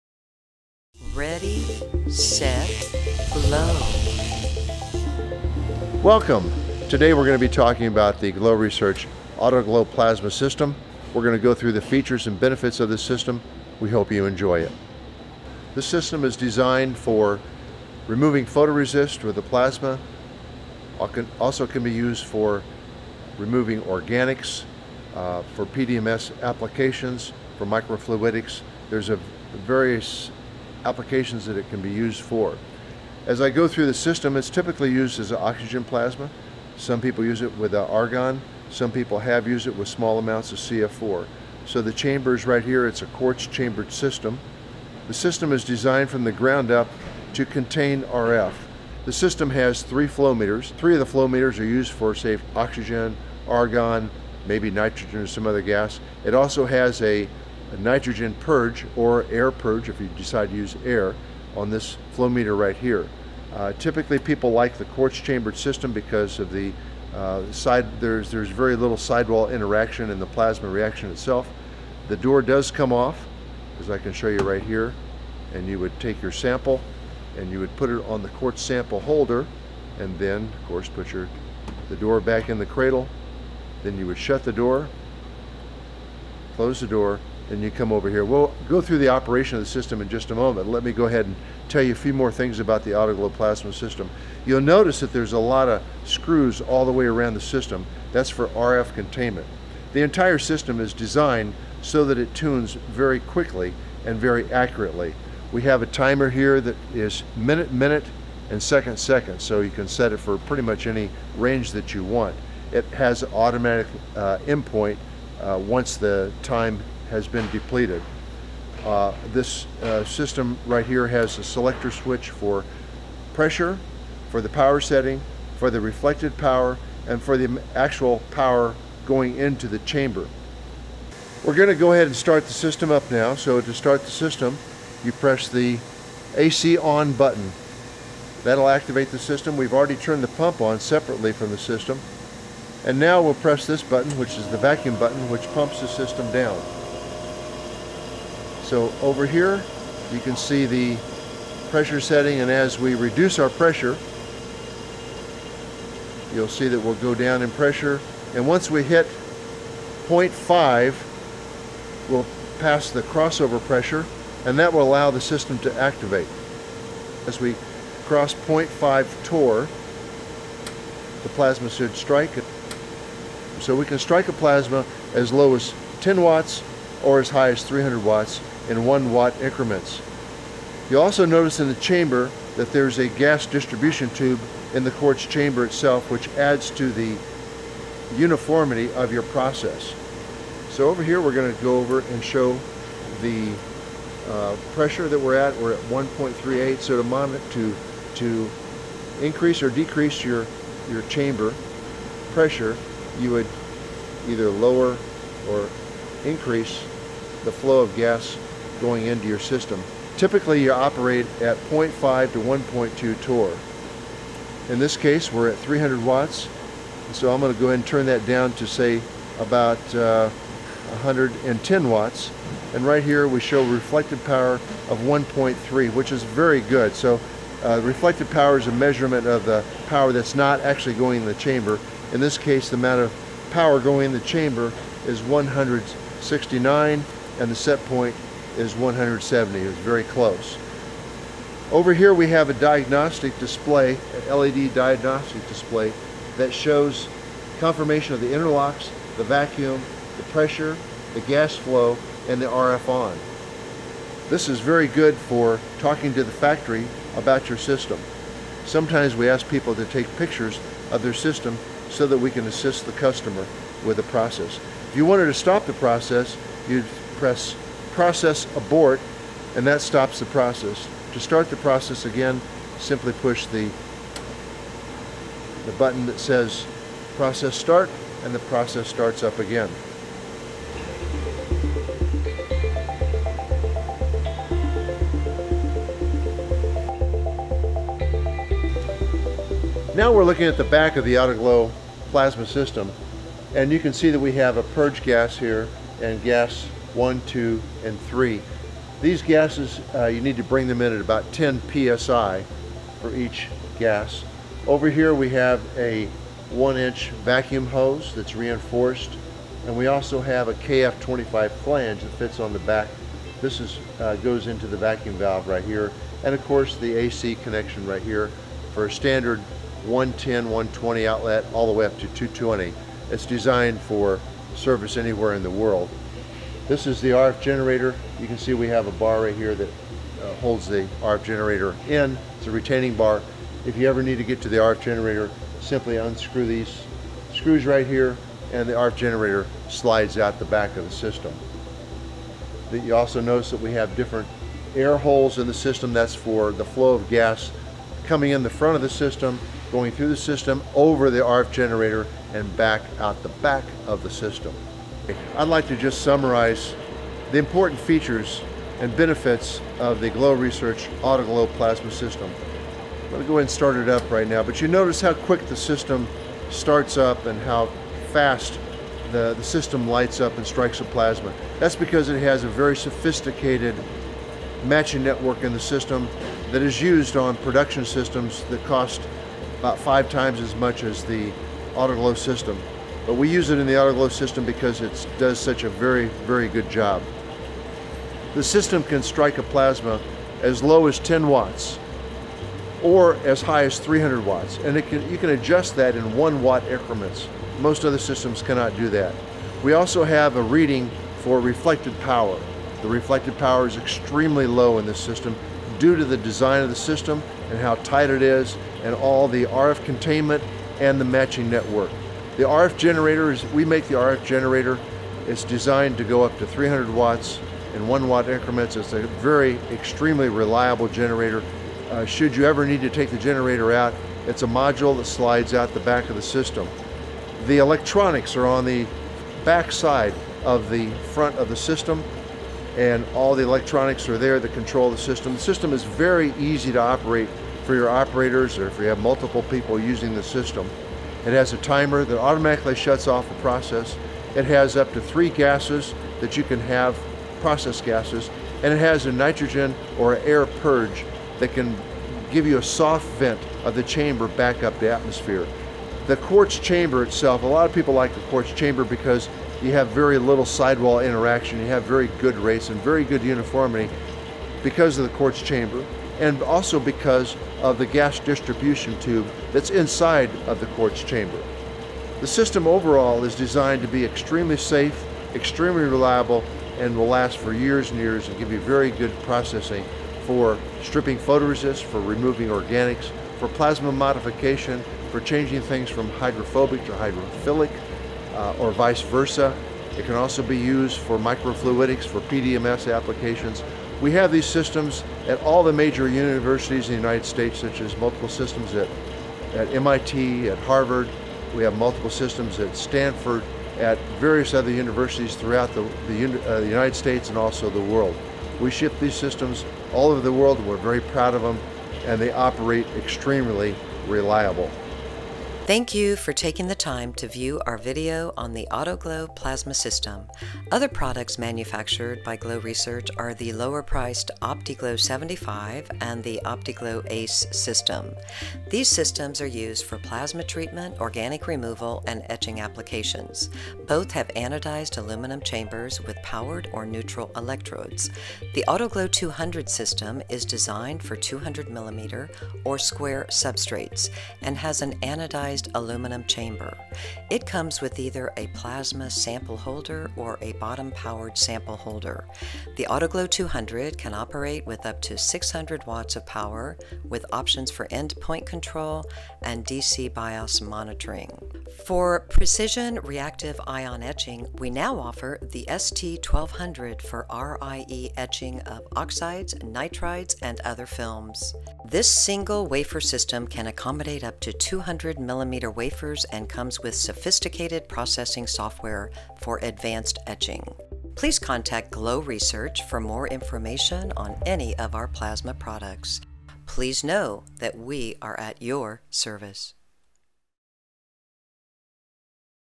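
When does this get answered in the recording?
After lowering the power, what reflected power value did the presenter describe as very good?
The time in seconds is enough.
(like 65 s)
223 s.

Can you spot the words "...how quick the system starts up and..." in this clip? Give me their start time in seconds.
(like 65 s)
365 s.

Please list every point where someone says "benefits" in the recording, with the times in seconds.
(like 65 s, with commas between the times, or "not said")
12 s, 358 s.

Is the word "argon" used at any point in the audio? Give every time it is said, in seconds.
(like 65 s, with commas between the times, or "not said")
37 s, 53 s.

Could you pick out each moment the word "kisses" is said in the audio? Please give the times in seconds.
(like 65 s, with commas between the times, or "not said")
not said.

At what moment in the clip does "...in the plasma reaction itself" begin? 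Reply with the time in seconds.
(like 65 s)
70 s.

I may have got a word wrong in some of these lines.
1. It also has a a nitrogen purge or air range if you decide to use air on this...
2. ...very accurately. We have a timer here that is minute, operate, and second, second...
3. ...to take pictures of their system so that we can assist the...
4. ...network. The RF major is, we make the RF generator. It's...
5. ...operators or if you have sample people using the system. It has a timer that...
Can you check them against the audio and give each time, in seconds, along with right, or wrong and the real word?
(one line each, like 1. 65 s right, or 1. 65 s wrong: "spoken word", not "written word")
1. 56 s wrong: "purge", not "range"
2. 104 s wrong: "minute", not "operate"
3. 259 s right
4. 411 s wrong: "generator", not "major"
5. 437 s wrong: "multiple", not "sample".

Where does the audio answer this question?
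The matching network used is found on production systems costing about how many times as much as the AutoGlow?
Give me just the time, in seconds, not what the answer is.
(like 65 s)
379 s.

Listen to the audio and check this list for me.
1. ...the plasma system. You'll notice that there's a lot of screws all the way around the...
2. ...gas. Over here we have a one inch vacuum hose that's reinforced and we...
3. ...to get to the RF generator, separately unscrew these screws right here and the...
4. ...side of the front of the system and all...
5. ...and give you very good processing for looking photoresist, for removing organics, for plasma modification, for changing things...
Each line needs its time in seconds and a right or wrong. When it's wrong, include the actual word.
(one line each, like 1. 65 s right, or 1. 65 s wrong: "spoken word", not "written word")
1. 92 s right
2. 303 s right
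3. 334 s wrong: "simply", not "separately"
4. 429 s right
5. 478 s wrong: "stripping", not "looking".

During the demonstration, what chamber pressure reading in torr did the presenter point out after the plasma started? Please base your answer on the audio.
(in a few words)
1.38.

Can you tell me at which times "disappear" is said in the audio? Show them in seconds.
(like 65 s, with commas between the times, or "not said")
not said.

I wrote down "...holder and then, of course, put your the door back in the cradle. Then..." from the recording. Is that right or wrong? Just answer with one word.
right.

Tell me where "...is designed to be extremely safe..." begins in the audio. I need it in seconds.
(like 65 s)
473 s.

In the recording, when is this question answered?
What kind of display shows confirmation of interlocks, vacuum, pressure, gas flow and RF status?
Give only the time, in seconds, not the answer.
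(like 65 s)
244 s.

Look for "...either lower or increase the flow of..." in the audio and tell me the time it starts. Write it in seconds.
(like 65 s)
204 s.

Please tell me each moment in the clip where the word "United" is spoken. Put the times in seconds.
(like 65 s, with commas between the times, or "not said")
496 s, 506 s.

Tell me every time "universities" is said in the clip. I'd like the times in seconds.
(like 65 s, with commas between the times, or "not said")
496 s, 504 s.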